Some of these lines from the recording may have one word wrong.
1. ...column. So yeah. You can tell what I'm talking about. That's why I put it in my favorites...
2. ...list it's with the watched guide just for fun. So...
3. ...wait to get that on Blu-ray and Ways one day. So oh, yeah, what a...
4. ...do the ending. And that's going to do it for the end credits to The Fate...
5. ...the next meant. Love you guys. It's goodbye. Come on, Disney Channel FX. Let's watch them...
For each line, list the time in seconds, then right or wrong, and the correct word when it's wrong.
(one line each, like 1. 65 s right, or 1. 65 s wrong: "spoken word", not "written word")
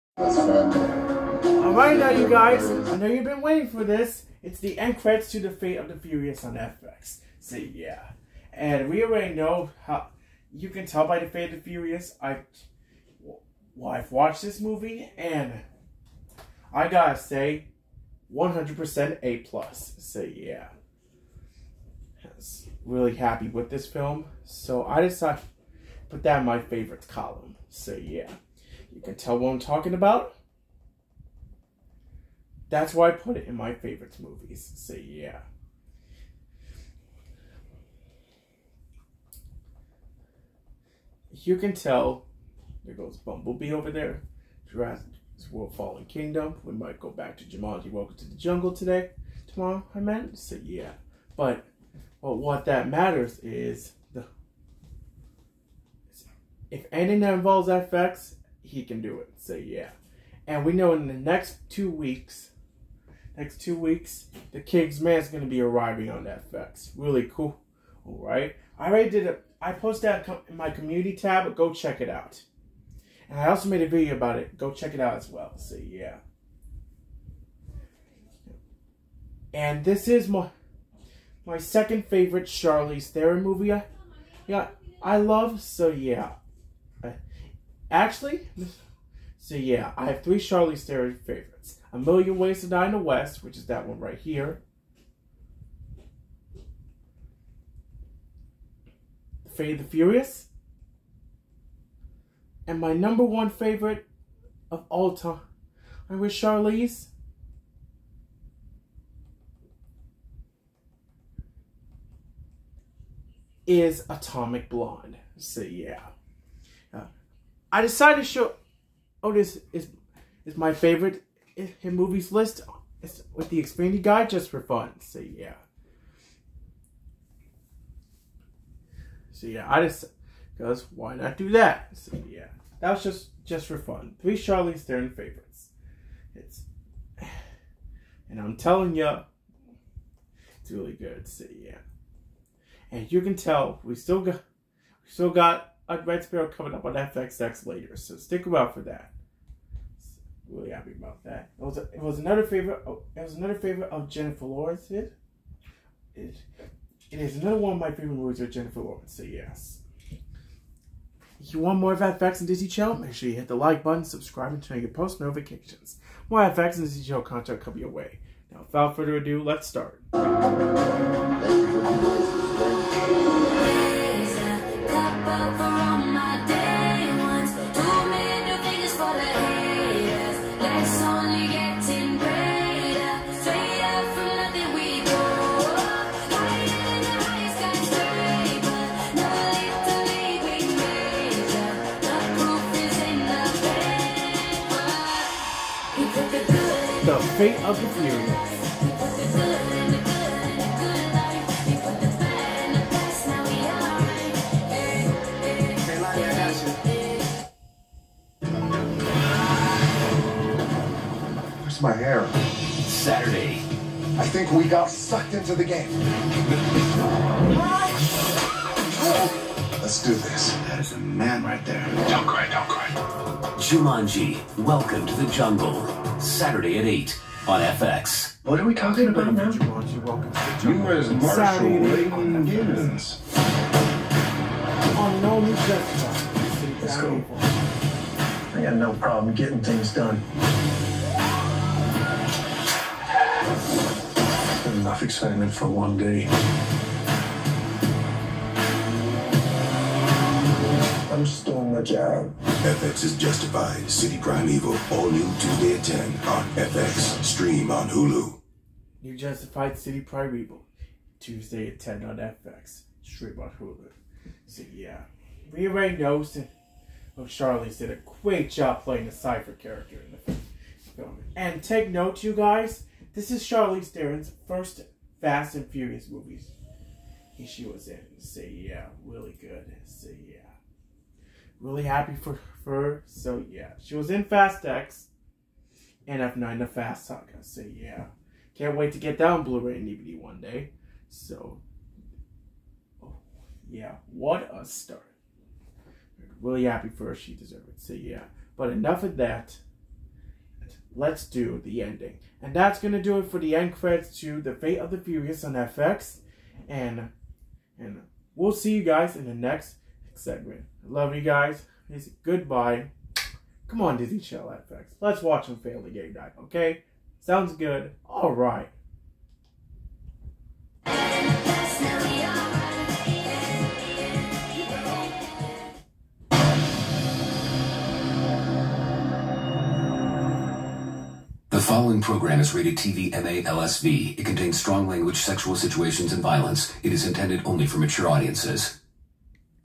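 1. 27 s right
2. 122 s wrong: "expanded", not "watched"
3. 288 s wrong: "DVD", not "Ways"
4. 301 s right
5. 309 s wrong: "segment", not "meant".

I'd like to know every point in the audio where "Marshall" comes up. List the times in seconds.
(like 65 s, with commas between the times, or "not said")
231 s.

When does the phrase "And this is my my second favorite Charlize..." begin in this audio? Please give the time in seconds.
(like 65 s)
79 s.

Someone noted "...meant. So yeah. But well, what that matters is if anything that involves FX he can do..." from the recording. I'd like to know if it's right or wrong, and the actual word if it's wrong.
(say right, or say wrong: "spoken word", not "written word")
right.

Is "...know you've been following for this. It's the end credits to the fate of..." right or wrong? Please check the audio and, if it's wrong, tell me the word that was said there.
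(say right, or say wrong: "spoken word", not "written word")
wrong: "waiting", not "following".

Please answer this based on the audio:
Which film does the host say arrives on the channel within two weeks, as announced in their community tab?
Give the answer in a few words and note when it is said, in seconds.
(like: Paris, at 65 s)
The King's Man, at 64 s.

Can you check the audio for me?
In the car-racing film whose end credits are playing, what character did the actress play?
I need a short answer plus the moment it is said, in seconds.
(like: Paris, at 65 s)
Cypher, at 269 s.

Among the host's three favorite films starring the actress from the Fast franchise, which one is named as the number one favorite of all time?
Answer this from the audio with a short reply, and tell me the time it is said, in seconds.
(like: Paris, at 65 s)
Atomic Blonde, at 114 s.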